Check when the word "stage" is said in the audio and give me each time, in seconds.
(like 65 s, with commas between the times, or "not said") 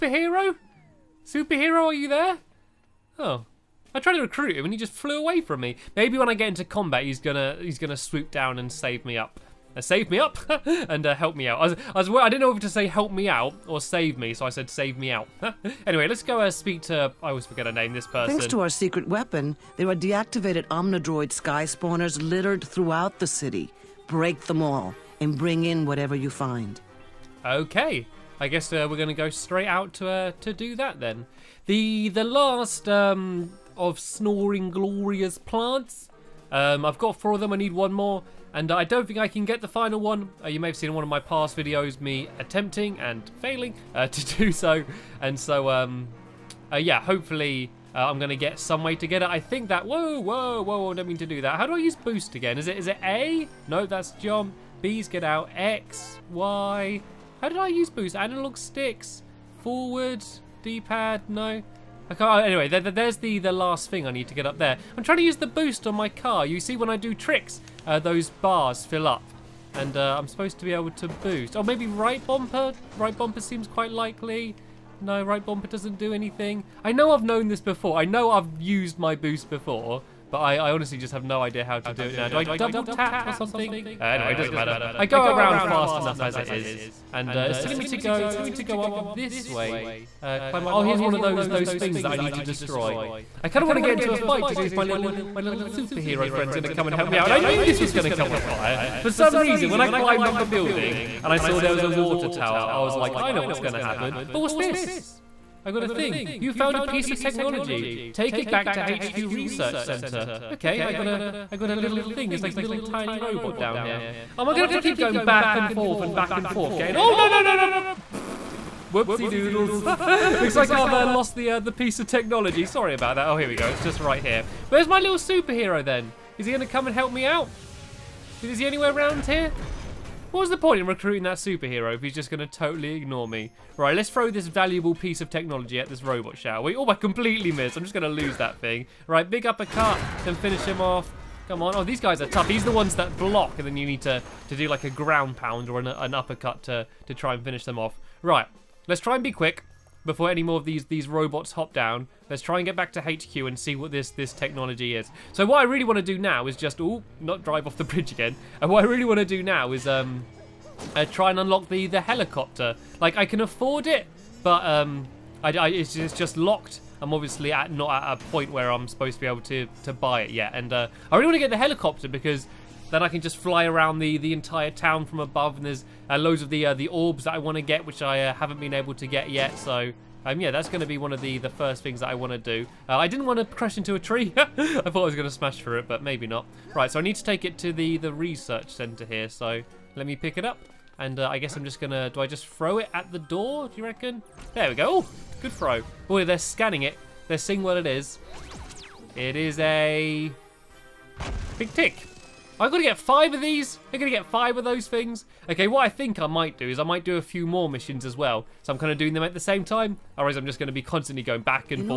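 not said.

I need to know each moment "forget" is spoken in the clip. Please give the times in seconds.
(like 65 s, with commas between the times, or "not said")
17 s.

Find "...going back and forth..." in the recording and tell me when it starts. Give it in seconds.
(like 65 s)
114 s.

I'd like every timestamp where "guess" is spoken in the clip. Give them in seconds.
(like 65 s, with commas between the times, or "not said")
28 s, 191 s.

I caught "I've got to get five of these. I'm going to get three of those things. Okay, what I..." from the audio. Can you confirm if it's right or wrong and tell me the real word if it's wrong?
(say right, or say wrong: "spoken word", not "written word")
wrong: "five", not "three".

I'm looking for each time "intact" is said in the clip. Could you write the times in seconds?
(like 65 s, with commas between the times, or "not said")
not said.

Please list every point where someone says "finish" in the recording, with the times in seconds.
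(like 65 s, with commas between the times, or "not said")
140 s, 147 s.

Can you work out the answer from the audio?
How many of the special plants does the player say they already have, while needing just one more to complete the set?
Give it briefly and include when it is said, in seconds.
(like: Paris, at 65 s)
4, at 37 s.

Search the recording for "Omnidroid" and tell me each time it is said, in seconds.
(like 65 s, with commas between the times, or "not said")
20 s.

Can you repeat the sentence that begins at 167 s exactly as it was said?
I'm obviously at not at a point where I'm supposed to be able to to buy it yet.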